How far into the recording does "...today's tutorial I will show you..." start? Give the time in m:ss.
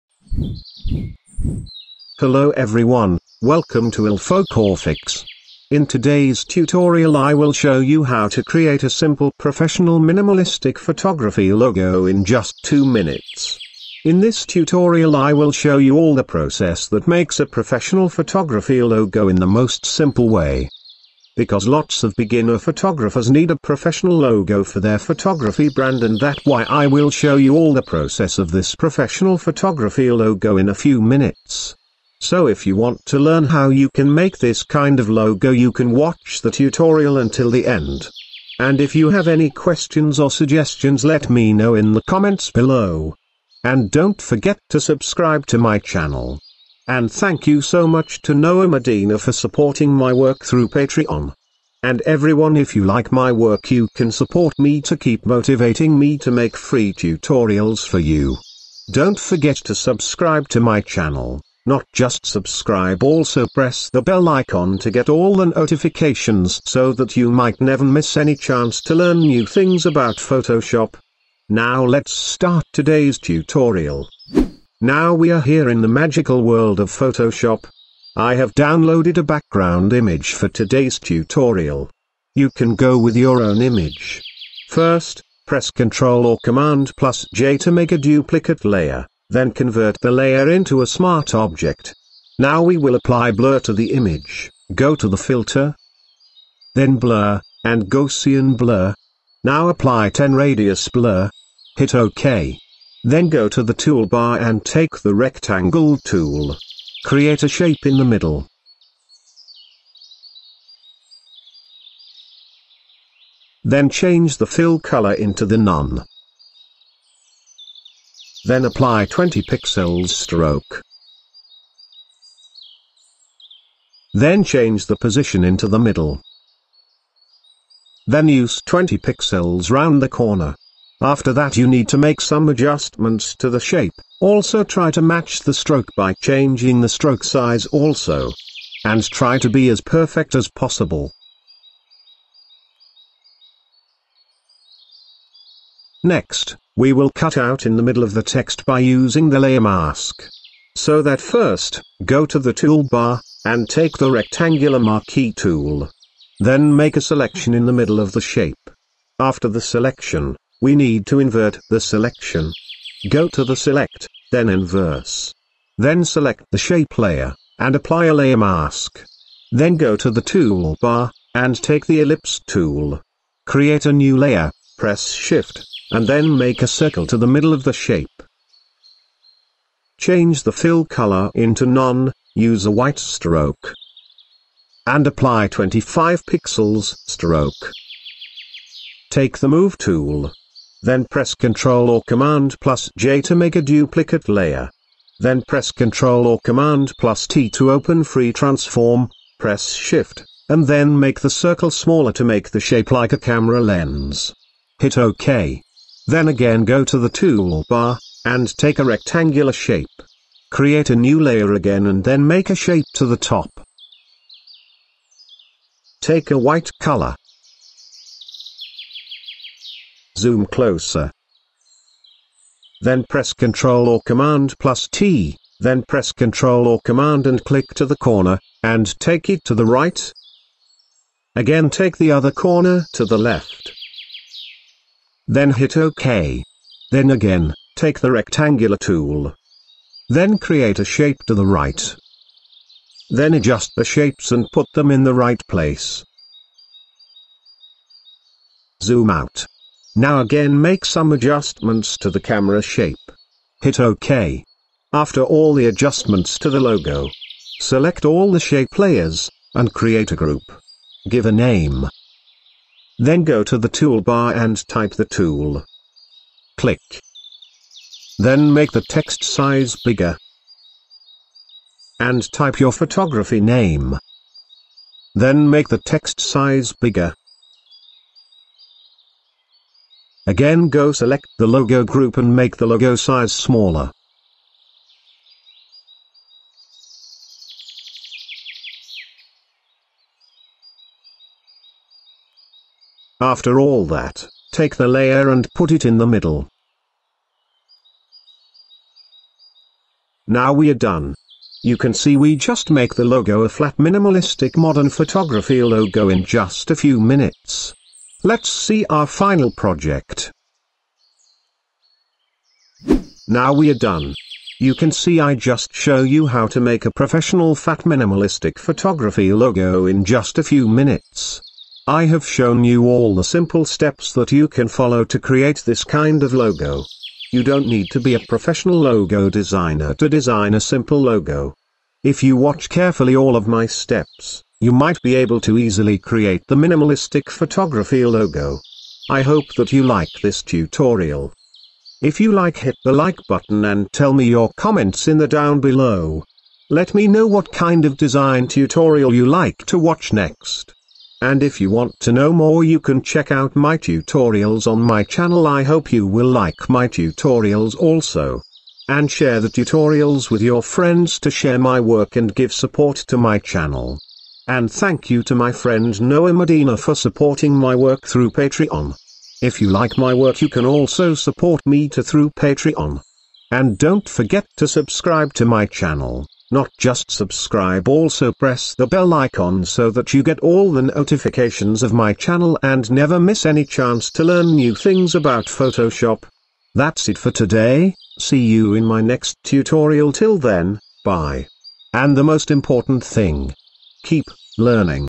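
0:05.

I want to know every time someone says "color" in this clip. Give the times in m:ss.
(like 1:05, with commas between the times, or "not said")
1:54, 3:00, 3:36.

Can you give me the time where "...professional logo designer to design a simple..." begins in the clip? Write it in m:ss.
5:28.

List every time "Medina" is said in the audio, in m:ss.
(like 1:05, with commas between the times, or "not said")
0:48, 6:06.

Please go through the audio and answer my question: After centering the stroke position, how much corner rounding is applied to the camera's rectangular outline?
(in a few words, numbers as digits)
20 pixels.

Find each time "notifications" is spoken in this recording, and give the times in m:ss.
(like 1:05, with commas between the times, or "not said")
1:05, 6:20.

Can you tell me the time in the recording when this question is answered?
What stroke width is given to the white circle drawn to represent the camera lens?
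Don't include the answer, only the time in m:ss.
3:05.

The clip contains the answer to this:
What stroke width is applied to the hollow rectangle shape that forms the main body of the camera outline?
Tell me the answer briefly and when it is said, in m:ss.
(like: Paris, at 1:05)
20 pixels, at 1:59.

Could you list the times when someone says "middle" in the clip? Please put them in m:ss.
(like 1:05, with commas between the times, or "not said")
1:48, 2:05, 2:27, 2:37, 2:57, 4:56.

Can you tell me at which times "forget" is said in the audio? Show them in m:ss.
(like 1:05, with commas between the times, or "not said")
0:44, 0:59, 6:14.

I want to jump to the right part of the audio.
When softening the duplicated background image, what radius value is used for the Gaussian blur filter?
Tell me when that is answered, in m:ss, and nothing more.
1:40.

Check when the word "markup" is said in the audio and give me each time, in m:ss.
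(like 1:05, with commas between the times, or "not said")
not said.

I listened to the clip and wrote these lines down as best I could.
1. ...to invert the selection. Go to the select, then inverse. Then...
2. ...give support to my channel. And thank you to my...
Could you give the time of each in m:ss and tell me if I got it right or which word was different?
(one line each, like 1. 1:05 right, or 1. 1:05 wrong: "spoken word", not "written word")
1. 2:41 right
2. 6:02 right.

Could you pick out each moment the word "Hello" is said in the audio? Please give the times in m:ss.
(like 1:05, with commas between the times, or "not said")
0:02.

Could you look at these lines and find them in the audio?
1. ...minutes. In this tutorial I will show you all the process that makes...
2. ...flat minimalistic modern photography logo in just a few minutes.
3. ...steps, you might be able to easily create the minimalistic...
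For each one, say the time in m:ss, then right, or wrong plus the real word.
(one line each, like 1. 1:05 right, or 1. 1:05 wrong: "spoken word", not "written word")
1. 0:12 right
2. 5:03 right
3. 5:33 right.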